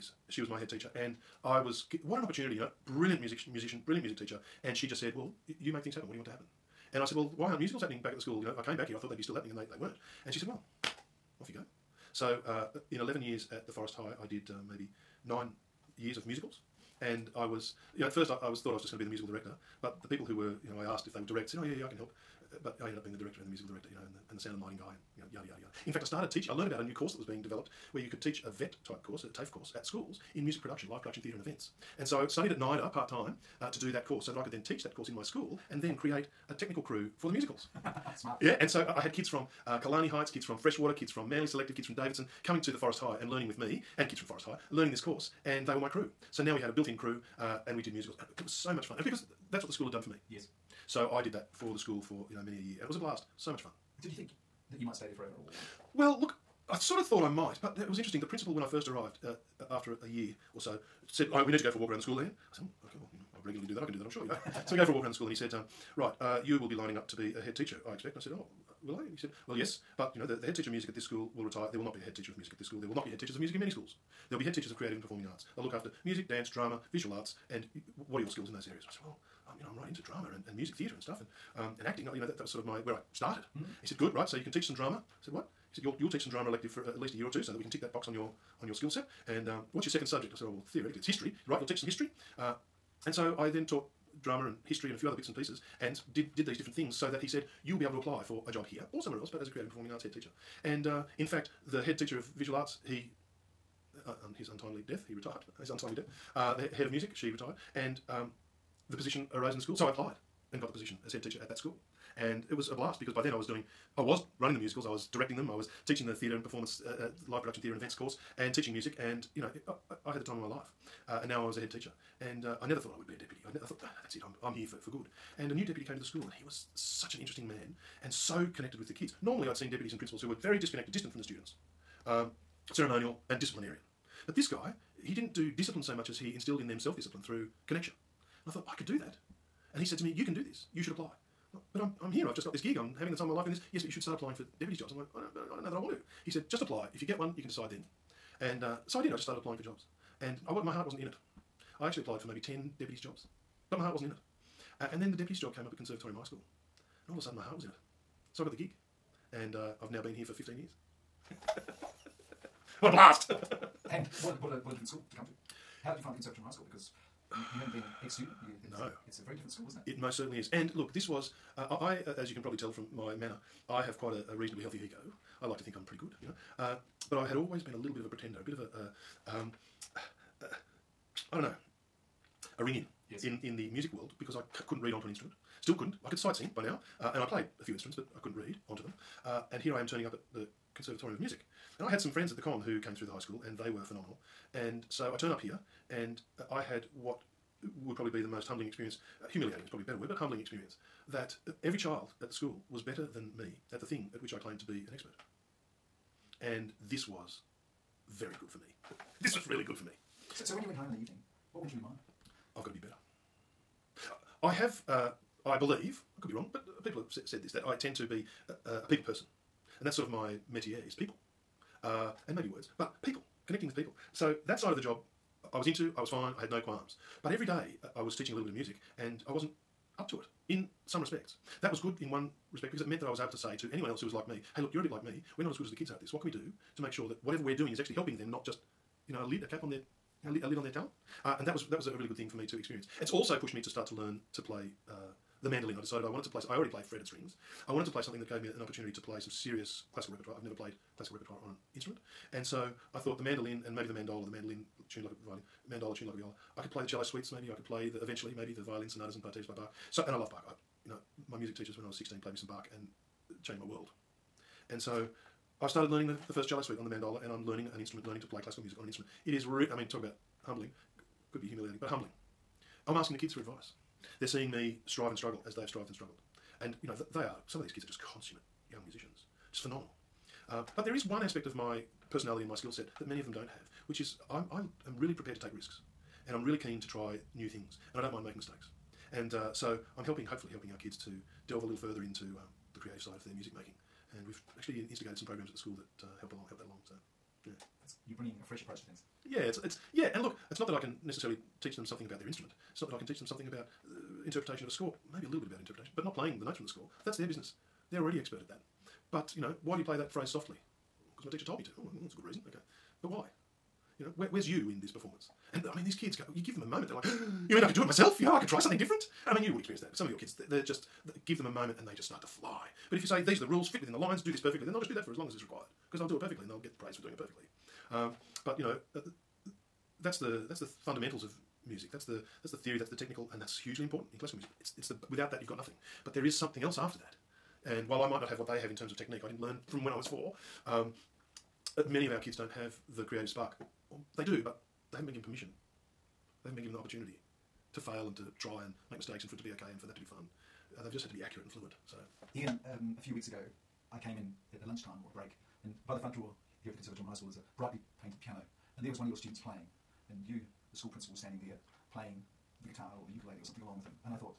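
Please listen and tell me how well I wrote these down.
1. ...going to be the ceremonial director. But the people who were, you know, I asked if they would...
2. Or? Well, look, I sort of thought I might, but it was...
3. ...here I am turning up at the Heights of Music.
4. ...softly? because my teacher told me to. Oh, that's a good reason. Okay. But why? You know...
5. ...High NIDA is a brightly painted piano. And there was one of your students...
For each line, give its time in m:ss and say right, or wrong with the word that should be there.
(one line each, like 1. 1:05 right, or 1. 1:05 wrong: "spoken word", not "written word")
1. 0:18 wrong: "musical", not "ceremonial"
2. 0:55 right
3. 3:09 wrong: "Conservatorium", not "Heights"
4. 5:10 right
5. 5:57 wrong: "School", not "NIDA".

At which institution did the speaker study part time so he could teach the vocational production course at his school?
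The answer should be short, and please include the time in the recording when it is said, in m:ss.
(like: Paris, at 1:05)
NIDA, at 0:32.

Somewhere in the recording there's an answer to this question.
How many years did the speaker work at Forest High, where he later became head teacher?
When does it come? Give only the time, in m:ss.
0:12.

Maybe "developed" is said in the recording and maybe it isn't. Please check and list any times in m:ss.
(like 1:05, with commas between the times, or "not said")
0:27.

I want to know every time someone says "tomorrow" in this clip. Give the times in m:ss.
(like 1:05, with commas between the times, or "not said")
not said.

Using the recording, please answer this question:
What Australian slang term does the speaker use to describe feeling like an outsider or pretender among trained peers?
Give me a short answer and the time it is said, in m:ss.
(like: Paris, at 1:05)
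ring in, at 3:02.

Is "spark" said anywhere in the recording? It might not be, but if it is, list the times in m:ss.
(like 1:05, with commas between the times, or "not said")
5:43.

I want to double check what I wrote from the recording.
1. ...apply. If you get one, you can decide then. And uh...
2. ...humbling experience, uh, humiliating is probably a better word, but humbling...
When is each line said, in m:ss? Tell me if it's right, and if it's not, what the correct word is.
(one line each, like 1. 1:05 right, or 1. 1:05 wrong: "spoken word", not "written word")
1. 2:26 right
2. 3:18 right.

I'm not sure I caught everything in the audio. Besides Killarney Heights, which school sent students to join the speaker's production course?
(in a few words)
Freshwater.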